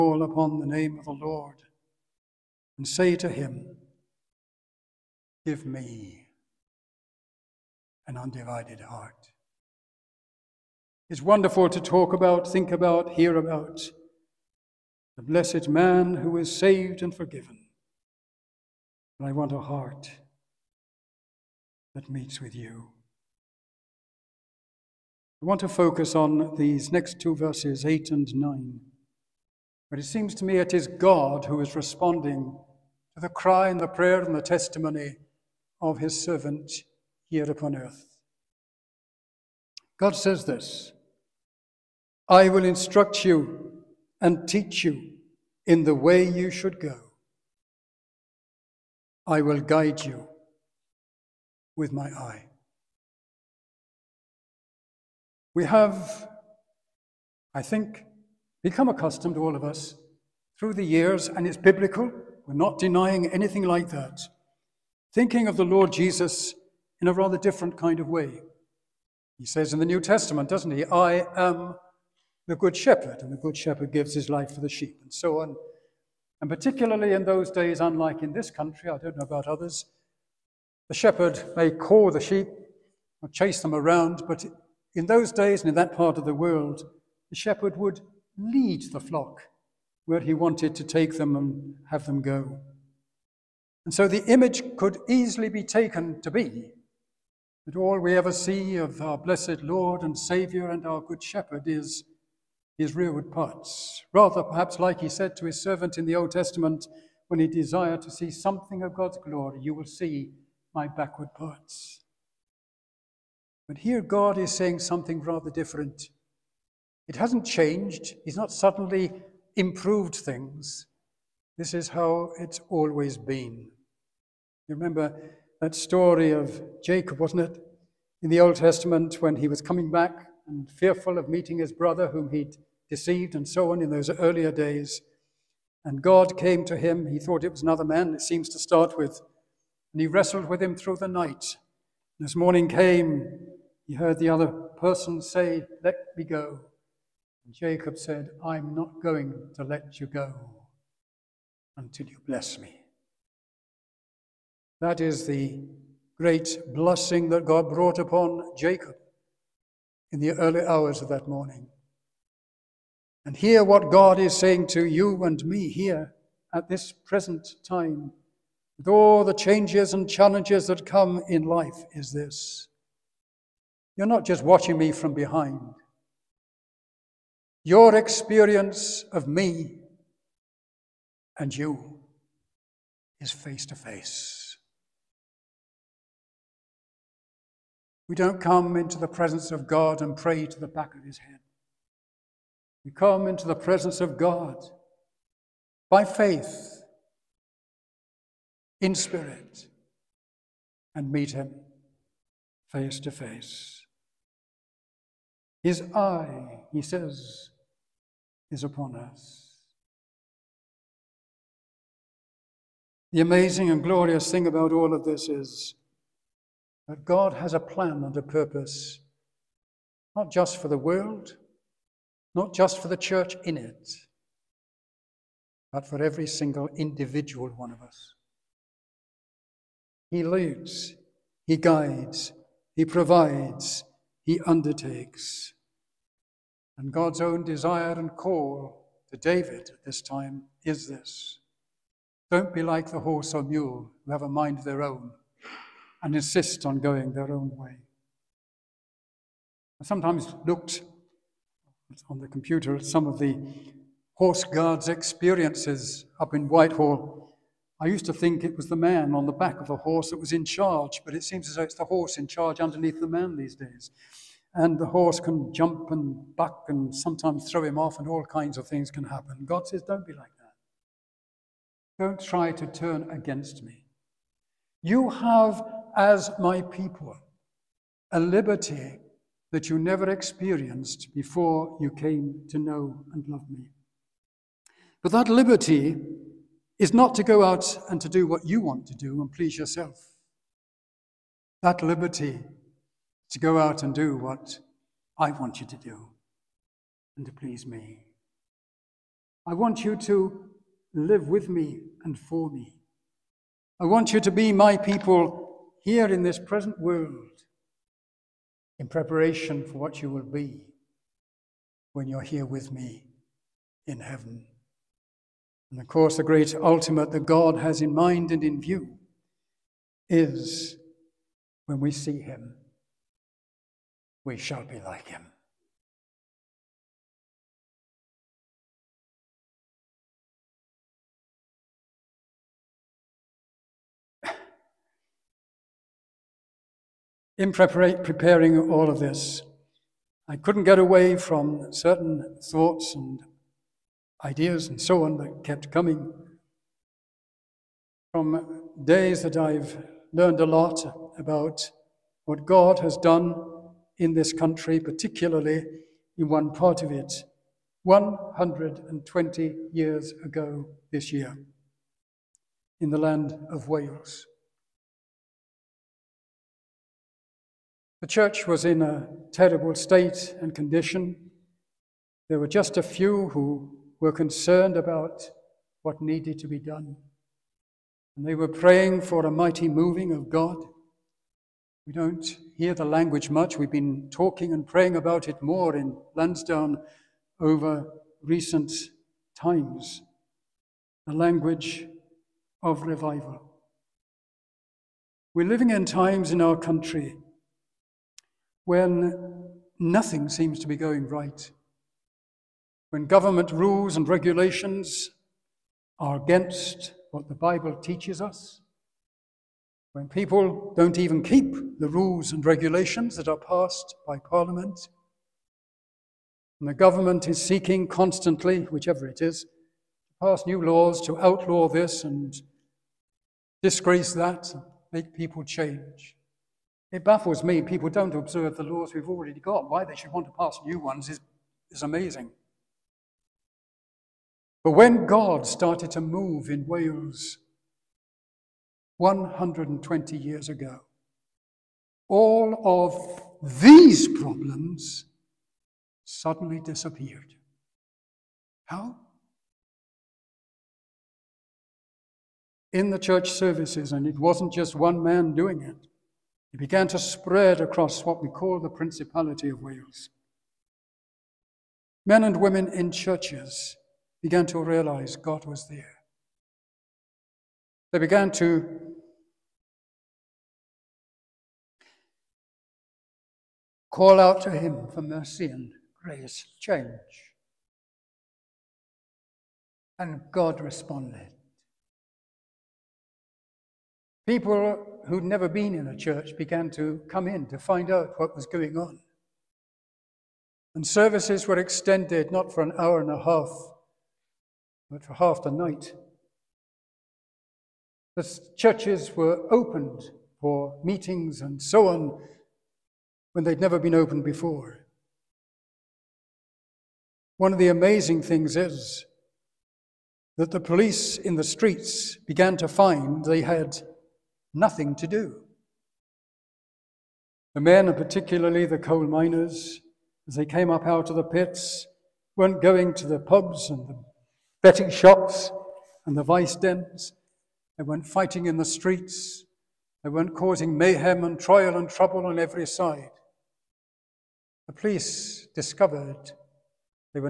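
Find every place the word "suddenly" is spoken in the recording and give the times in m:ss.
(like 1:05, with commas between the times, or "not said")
1:58, 7:26.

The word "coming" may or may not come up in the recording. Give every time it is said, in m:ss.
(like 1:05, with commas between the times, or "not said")
2:09, 5:45.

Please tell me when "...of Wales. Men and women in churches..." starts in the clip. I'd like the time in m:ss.
7:39.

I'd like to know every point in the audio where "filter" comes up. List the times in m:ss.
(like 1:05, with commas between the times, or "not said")
not said.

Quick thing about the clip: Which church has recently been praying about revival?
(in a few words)
Lansdowne.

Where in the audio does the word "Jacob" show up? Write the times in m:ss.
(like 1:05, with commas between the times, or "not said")
2:06, 2:27, 2:38.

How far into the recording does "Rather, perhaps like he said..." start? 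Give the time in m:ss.
1:44.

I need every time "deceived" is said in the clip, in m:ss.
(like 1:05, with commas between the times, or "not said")
2:12.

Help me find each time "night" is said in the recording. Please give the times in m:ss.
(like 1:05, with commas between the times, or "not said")
2:21, 8:15.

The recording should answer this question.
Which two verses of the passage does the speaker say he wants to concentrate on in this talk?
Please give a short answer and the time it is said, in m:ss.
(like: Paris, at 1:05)
8 and 9, at 0:27.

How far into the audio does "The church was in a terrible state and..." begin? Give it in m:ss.
6:08.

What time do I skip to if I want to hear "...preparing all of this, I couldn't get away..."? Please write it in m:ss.
5:37.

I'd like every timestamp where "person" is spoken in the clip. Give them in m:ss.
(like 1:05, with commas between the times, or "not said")
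2:24.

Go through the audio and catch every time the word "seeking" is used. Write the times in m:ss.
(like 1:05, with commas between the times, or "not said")
6:57.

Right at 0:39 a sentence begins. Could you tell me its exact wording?
God says this I will instruct you and teach you in the way you should go.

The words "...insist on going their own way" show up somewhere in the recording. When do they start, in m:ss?
4:06.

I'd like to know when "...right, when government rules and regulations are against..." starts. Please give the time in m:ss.
6:41.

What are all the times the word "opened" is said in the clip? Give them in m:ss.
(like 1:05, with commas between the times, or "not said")
8:19, 8:23.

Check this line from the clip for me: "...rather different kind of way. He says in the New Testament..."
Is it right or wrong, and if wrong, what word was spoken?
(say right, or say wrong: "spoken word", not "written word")
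right.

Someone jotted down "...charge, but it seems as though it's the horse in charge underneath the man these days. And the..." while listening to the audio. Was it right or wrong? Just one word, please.
right.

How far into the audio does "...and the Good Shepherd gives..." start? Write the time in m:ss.
1:13.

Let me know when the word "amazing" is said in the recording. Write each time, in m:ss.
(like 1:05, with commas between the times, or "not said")
3:33, 7:11, 8:27.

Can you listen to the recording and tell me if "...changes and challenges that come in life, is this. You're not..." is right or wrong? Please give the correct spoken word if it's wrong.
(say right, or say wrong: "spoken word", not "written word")
right.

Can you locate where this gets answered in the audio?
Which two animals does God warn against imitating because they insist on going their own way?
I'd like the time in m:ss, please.
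4:02.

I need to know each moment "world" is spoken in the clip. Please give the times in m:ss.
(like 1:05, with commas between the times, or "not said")
1:26, 3:40, 5:06.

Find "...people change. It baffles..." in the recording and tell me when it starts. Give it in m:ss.
7:05.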